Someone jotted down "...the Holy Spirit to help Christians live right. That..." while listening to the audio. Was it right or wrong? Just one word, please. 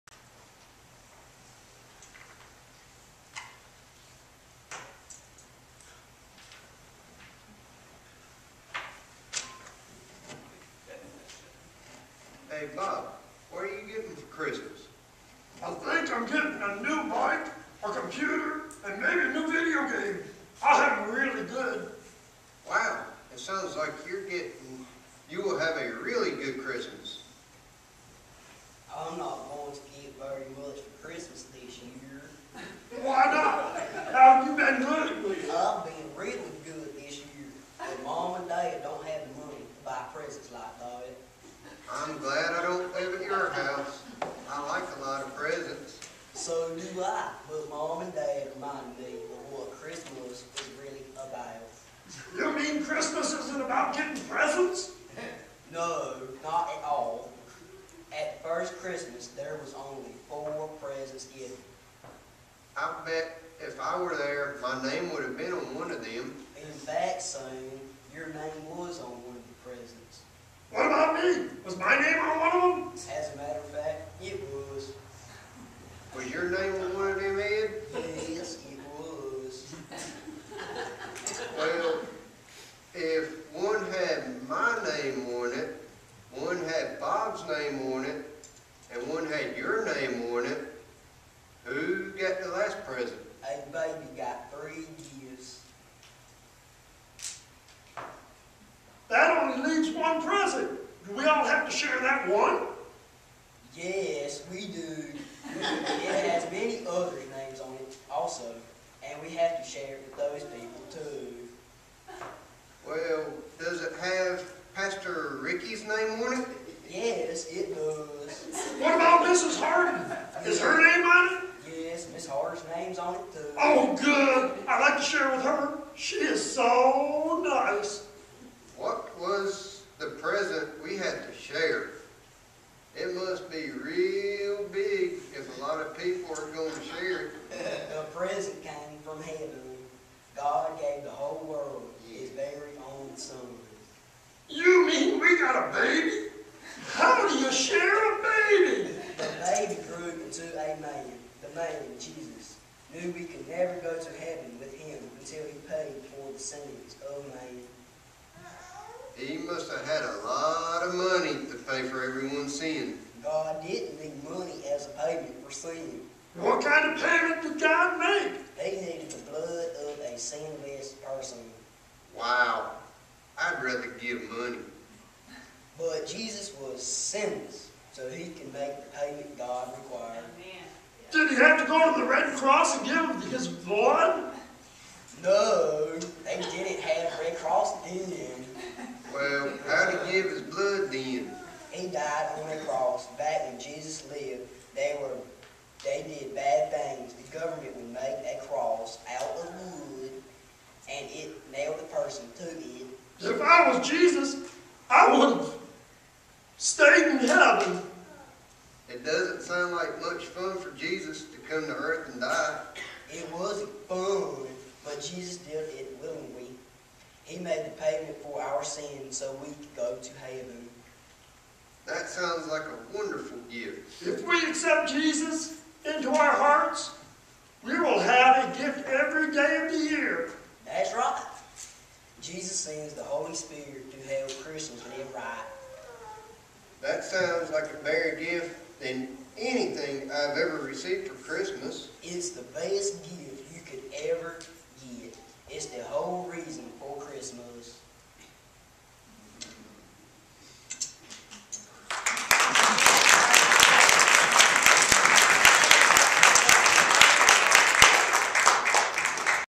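right.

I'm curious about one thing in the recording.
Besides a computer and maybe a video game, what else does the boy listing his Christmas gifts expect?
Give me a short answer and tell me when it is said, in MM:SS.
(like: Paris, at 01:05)
A new bike, at 00:16.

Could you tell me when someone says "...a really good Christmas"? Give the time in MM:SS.
00:25.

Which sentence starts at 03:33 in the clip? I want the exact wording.
It wasn't fun, but Jesus did it willingly.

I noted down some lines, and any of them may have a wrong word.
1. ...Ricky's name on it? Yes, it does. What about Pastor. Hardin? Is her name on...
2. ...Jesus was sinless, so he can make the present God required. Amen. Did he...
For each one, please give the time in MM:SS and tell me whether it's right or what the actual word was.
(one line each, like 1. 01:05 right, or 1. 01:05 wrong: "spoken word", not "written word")
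1. 01:55 wrong: "Mrs", not "Pastor"
2. 02:56 wrong: "payment", not "present".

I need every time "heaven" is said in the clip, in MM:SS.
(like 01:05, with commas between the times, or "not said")
02:34, 03:27, 03:40.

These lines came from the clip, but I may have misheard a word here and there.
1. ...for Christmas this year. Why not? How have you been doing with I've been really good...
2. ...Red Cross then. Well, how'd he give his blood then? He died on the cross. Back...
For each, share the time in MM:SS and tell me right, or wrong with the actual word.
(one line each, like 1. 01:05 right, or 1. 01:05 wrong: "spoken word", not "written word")
1. 00:30 right
2. 03:07 right.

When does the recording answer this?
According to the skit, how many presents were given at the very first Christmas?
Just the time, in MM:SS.
01:00.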